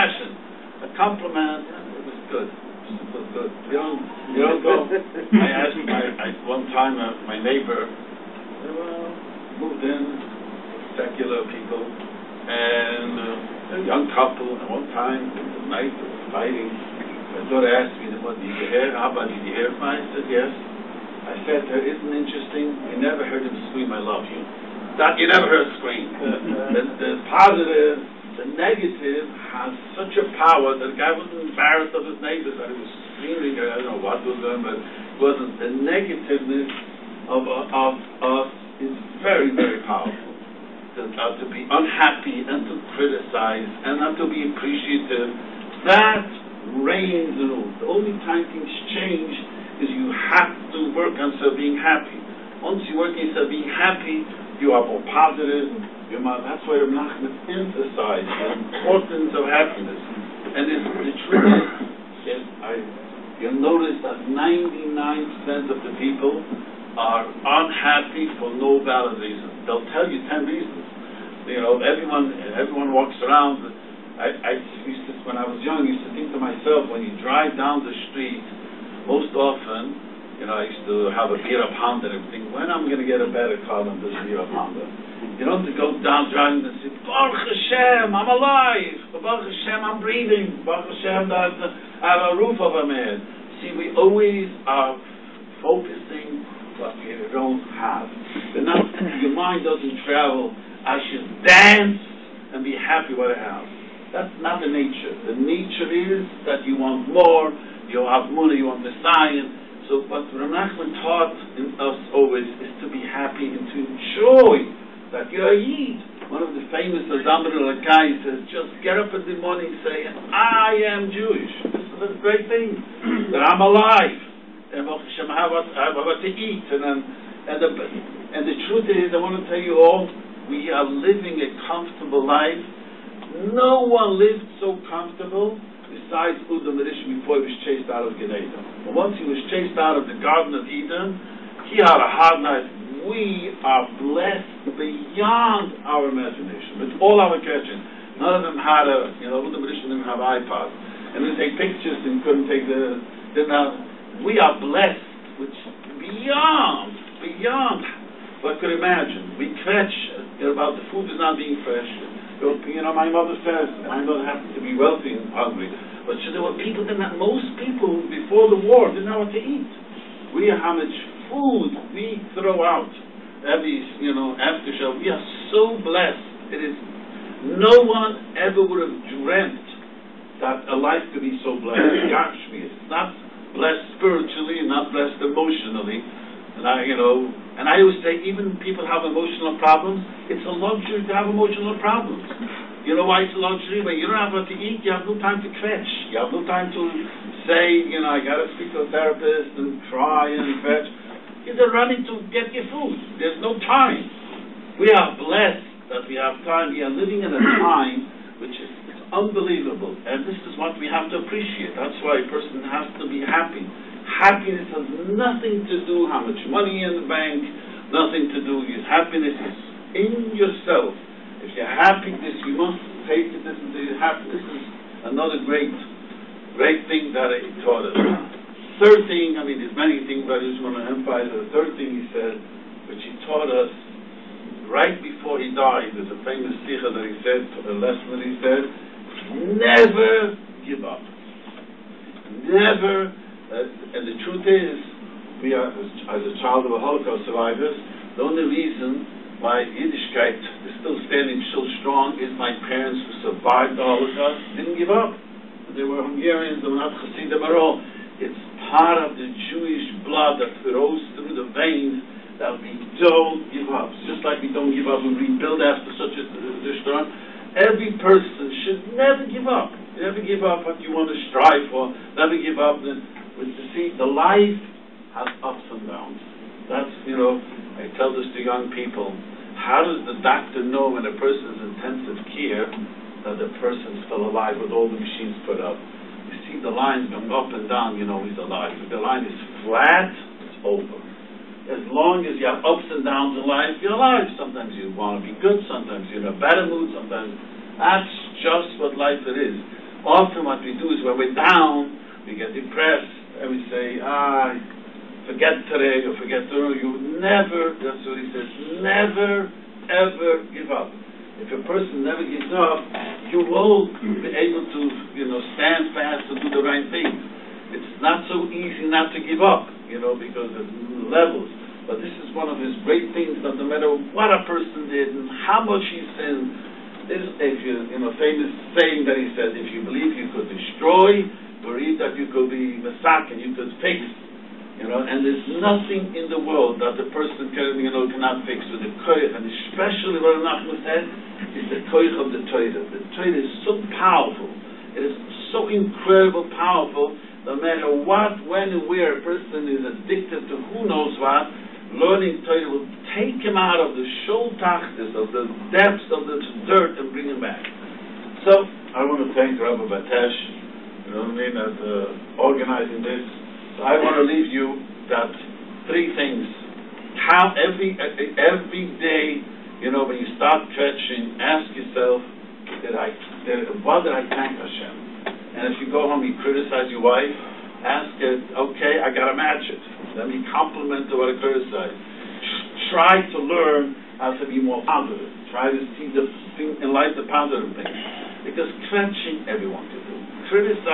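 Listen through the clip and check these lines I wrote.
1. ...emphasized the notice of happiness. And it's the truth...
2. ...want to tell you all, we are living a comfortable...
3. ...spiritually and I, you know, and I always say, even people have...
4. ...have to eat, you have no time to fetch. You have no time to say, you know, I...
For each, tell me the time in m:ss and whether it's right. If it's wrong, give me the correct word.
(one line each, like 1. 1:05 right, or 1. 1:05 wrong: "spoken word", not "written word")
1. 0:57 wrong: "importance", not "notice"
2. 2:09 right
3. 3:05 wrong: "emotionally", not "spiritually"
4. 3:14 right.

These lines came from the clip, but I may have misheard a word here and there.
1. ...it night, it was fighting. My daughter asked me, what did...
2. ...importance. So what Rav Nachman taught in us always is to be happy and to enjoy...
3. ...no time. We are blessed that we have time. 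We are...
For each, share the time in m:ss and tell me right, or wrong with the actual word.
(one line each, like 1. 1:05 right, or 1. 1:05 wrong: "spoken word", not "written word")
1. 0:15 right
2. 1:49 wrong: "science", not "importance"
3. 3:23 right.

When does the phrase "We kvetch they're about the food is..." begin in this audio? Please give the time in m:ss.
2:39.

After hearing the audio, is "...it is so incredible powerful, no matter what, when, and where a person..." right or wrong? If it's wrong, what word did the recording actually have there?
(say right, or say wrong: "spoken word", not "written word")
right.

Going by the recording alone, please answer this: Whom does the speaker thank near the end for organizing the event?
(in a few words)
Rabbi Batesh.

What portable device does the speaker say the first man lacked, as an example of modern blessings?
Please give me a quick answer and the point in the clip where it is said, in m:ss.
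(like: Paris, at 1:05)
iPods, at 2:30.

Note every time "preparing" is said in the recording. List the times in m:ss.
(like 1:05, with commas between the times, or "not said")
not said.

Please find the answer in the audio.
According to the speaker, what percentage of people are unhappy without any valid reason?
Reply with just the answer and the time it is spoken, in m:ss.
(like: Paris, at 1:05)
99%, at 1:04.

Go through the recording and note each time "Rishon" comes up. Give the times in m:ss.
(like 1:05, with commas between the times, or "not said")
2:16, 2:29.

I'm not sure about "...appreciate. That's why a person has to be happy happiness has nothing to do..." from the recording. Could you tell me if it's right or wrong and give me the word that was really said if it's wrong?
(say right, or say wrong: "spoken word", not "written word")
right.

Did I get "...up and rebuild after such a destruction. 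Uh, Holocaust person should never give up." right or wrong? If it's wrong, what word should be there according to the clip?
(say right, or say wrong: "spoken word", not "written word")
wrong: "Every", not "Holocaust".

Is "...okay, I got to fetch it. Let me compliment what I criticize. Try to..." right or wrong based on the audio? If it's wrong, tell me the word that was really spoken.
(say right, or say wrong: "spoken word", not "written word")
wrong: "match", not "fetch".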